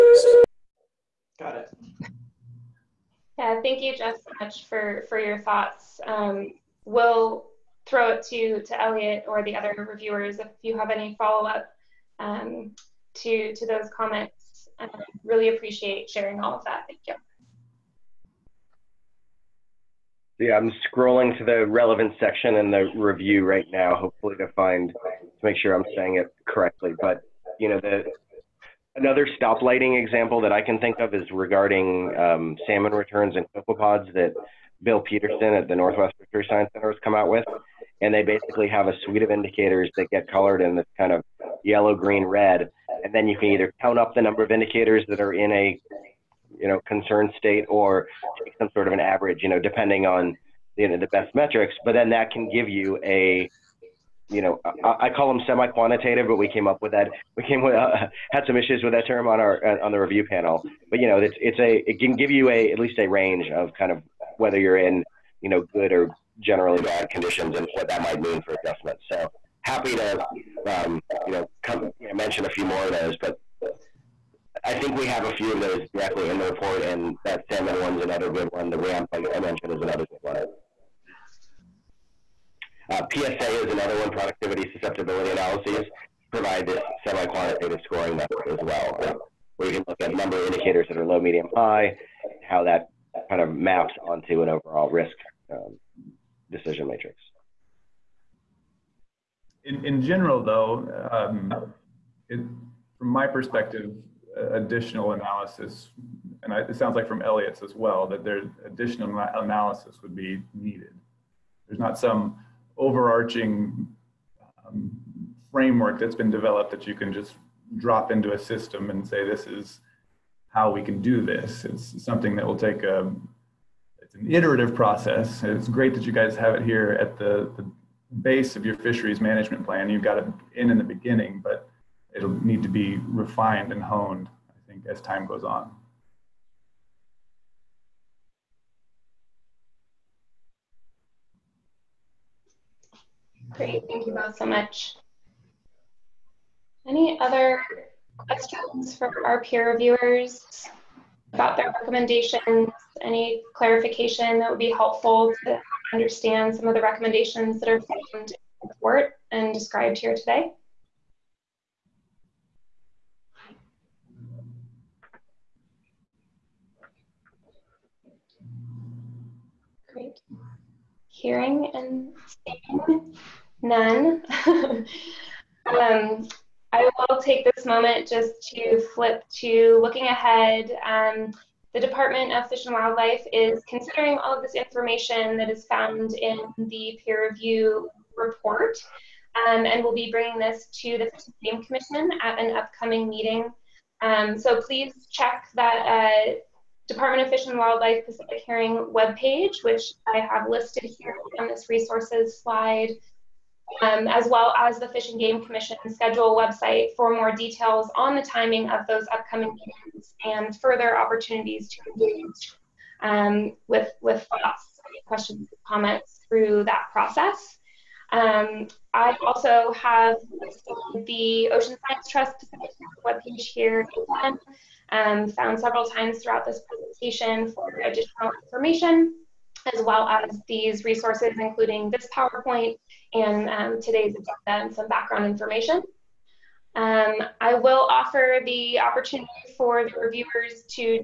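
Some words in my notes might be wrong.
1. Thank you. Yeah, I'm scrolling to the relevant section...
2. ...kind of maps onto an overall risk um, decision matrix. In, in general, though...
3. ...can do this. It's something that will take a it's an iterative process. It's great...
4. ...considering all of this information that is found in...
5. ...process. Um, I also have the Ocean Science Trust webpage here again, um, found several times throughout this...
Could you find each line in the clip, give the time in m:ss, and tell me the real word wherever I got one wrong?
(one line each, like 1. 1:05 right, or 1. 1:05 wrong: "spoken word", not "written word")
1. 0:16 right
2. 1:33 right
3. 2:00 right
4. 3:03 right
5. 3:36 right.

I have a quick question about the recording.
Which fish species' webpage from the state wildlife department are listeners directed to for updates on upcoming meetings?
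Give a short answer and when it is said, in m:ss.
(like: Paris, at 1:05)
Pacific Herring, at 3:18.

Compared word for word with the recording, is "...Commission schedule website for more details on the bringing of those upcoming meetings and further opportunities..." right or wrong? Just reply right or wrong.
wrong.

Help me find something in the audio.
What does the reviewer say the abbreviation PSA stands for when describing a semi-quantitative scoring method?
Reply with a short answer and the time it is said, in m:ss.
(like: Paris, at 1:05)
productivity susceptibility analyses, at 1:24.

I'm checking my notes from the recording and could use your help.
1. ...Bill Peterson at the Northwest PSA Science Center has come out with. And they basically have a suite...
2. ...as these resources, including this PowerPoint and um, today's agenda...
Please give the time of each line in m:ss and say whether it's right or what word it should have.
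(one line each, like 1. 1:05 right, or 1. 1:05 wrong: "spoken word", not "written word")
1. 0:34 wrong: "Fishery", not "PSA"
2. 3:50 right.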